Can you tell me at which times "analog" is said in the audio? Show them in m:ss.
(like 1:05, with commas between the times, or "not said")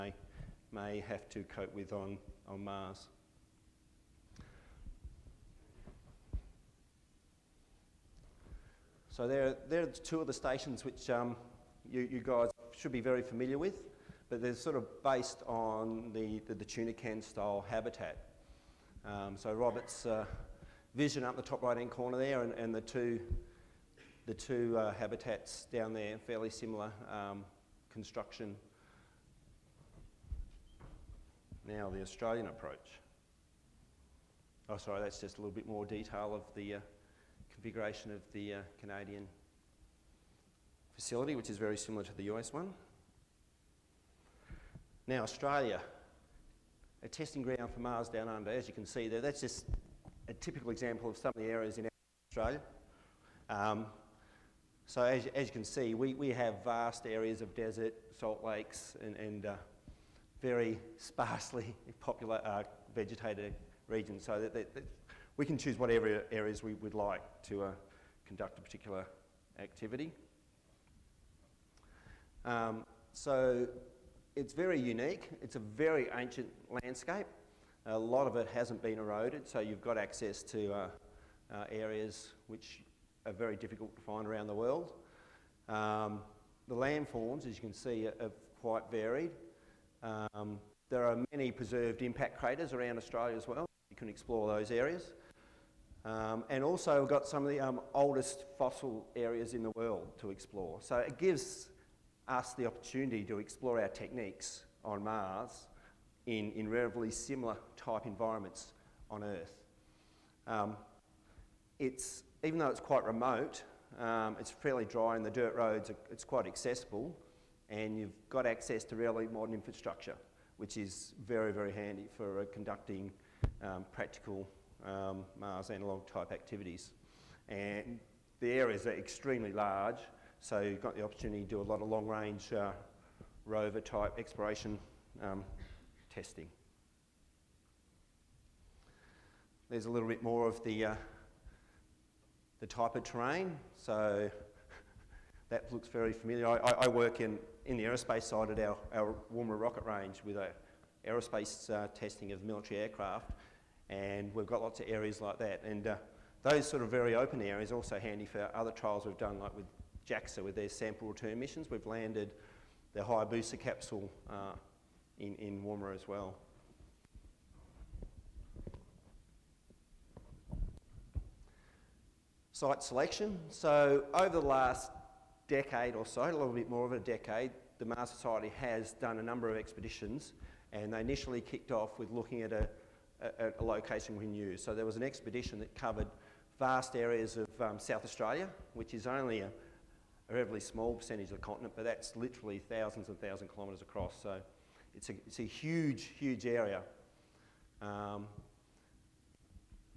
2:05.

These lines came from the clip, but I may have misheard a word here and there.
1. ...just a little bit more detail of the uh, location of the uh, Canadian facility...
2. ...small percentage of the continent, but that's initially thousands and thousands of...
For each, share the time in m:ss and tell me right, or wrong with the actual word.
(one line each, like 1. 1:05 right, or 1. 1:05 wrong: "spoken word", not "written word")
1. 0:35 wrong: "configuration", not "location"
2. 3:10 wrong: "literally", not "initially".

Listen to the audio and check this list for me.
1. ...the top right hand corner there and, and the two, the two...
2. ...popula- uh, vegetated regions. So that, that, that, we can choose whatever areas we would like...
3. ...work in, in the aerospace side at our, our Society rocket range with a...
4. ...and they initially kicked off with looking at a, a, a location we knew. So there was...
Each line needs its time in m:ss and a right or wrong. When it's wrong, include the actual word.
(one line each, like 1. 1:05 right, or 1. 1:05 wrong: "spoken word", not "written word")
1. 0:21 right
2. 1:02 right
3. 2:26 wrong: "Woomera", not "Society"
4. 3:00 right.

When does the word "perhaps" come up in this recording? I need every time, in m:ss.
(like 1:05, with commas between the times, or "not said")
not said.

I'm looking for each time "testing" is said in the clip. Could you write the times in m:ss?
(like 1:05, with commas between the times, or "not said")
0:47, 2:16, 2:31.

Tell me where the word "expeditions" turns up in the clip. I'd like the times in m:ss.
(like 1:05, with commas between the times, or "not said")
2:59, 3:05.